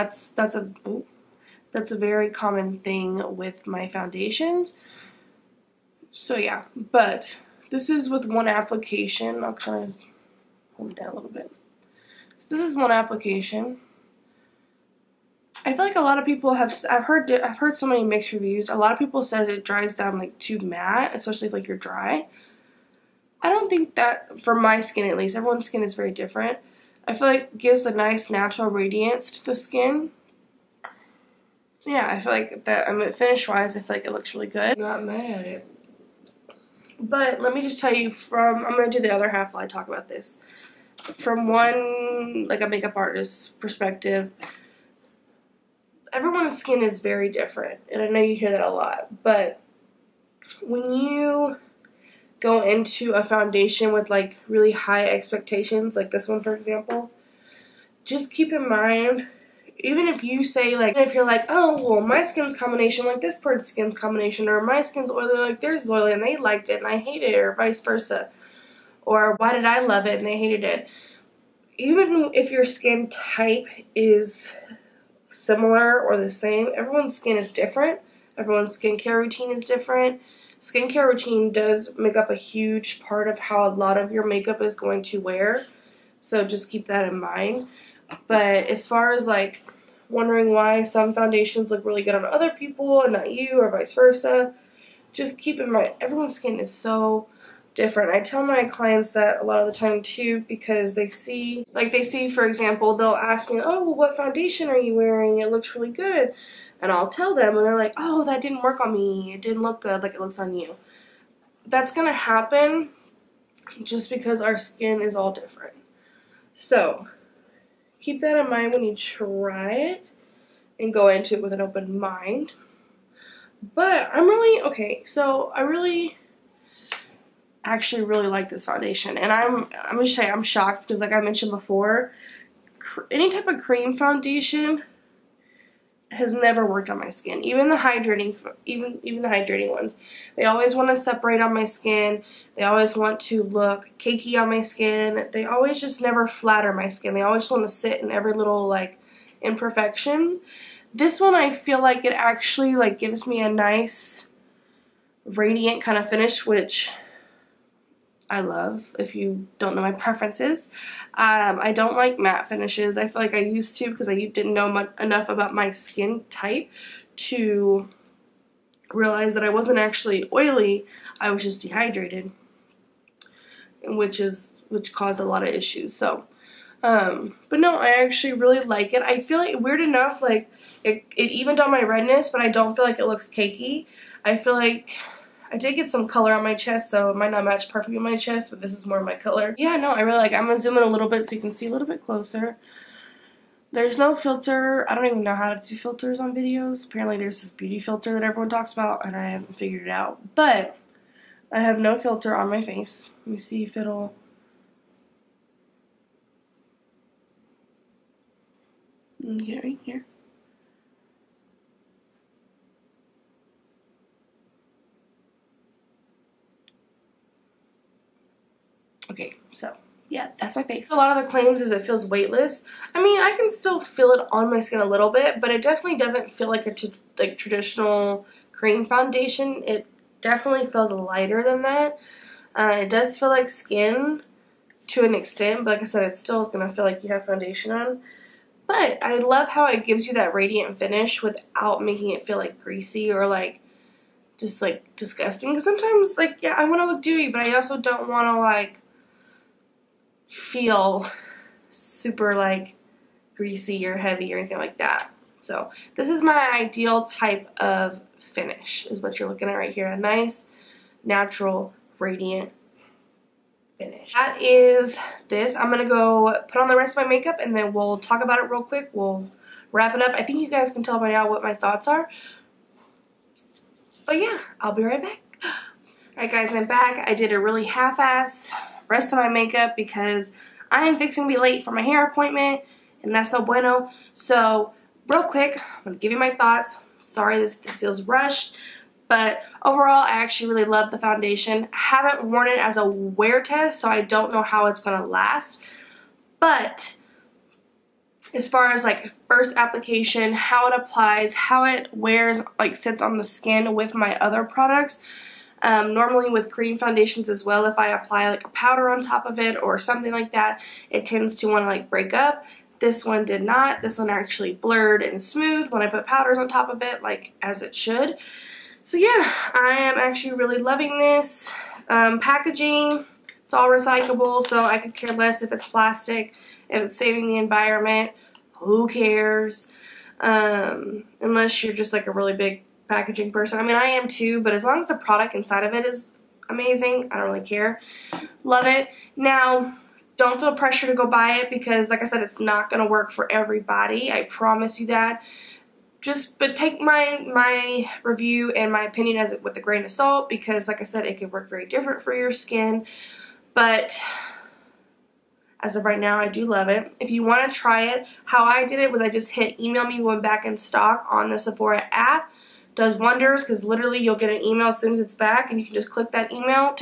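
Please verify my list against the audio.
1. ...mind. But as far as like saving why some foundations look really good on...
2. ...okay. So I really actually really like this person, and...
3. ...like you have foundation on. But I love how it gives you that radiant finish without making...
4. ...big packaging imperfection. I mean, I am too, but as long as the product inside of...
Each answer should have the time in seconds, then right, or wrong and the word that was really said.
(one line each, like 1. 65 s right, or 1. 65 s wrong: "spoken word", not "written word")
1. 87 s wrong: "wondering", not "saving"
2. 124 s wrong: "foundation", not "person"
3. 236 s right
4. 332 s wrong: "person", not "imperfection".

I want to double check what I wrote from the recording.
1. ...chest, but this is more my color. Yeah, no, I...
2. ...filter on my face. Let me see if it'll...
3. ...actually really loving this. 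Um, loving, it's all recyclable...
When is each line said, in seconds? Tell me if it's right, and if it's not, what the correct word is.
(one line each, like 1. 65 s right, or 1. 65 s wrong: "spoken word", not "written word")
1. 188 s right
2. 201 s right
3. 319 s wrong: "packaging", not "loving".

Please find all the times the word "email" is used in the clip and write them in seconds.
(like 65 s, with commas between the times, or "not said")
359 s, 364 s.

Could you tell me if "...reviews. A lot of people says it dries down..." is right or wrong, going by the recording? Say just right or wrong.
right.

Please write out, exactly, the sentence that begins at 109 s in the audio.
It didn't look good like it looks on you." That's gonna happen just because our skin is all different.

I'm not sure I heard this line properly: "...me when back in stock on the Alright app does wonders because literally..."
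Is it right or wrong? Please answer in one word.
wrong.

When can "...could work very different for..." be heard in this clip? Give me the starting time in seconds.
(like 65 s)
351 s.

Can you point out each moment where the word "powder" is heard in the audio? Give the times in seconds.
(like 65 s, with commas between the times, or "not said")
308 s, 316 s.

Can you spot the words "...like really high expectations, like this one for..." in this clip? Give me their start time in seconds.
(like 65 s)
54 s.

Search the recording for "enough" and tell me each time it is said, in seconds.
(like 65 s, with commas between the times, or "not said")
165 s, 179 s.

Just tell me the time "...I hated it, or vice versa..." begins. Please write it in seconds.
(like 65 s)
66 s.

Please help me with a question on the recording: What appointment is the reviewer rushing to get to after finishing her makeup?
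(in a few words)
Hair appointment.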